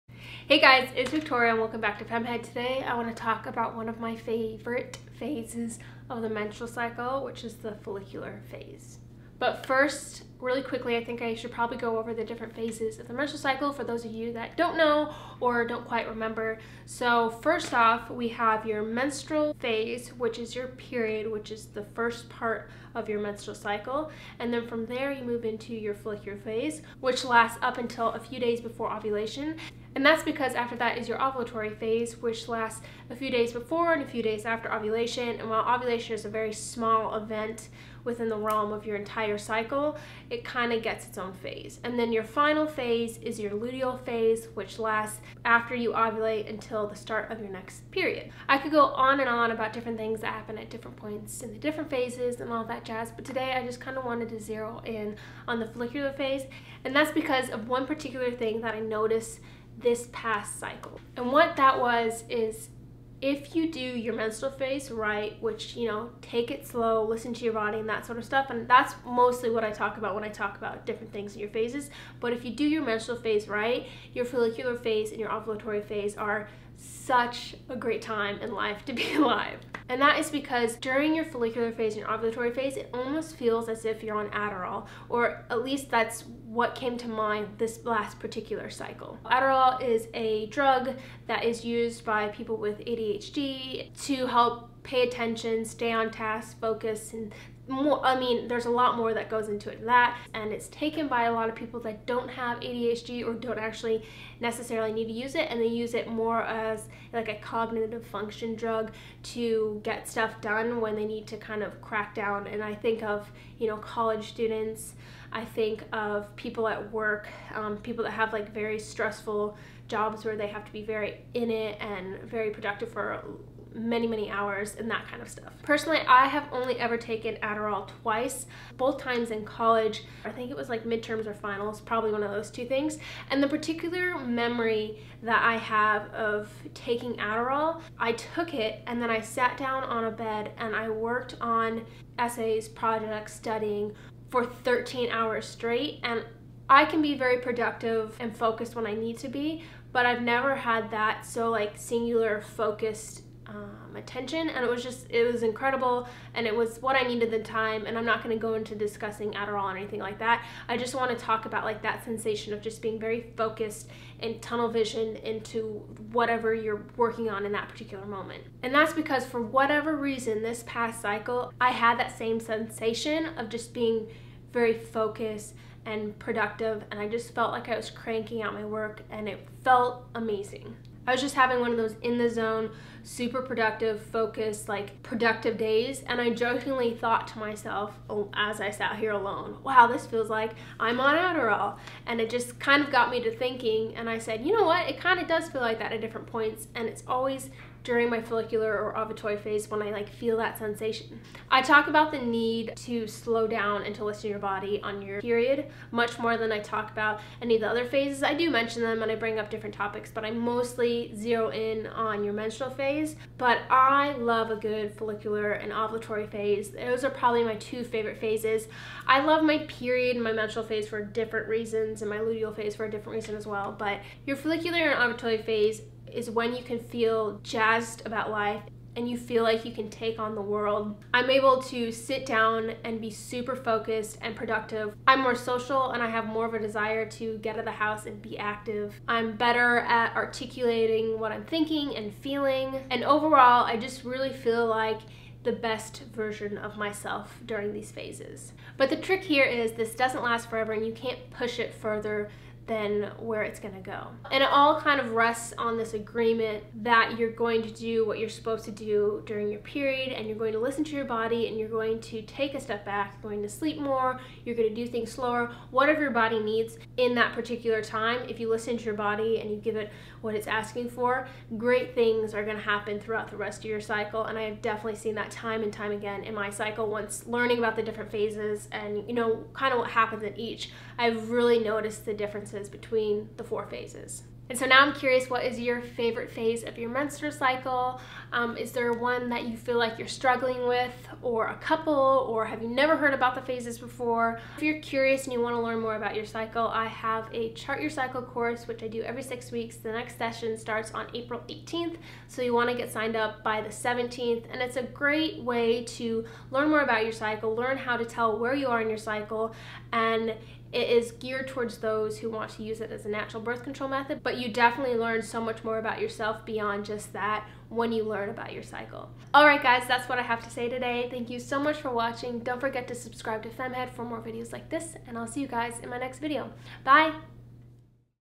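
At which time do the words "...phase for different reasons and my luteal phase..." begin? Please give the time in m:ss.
3:40.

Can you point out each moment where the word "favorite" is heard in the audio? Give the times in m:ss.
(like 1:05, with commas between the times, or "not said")
0:04, 3:37, 4:45.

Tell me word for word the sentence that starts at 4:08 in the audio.
But the trick here is this doesn't last forever and you can't push it further than where it's going to go.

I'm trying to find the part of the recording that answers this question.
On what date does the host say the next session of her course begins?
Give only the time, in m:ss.
5:01.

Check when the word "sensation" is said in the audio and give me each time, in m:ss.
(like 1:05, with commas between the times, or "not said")
2:42, 2:52, 3:20.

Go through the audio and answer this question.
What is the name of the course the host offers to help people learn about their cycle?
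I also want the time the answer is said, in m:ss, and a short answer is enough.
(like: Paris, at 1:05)
Chart Your Cycle, at 4:57.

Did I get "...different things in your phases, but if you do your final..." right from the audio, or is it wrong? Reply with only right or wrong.
wrong.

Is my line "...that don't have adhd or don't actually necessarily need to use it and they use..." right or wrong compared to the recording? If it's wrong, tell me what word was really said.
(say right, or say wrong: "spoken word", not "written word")
right.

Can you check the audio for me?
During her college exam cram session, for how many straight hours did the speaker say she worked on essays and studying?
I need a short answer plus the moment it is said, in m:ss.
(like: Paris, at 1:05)
13, at 2:24.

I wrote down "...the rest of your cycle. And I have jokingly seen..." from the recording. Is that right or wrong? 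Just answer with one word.
wrong.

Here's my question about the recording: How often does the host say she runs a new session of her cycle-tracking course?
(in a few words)
every 6 weeks.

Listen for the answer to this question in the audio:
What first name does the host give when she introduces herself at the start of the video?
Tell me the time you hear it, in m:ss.
0:01.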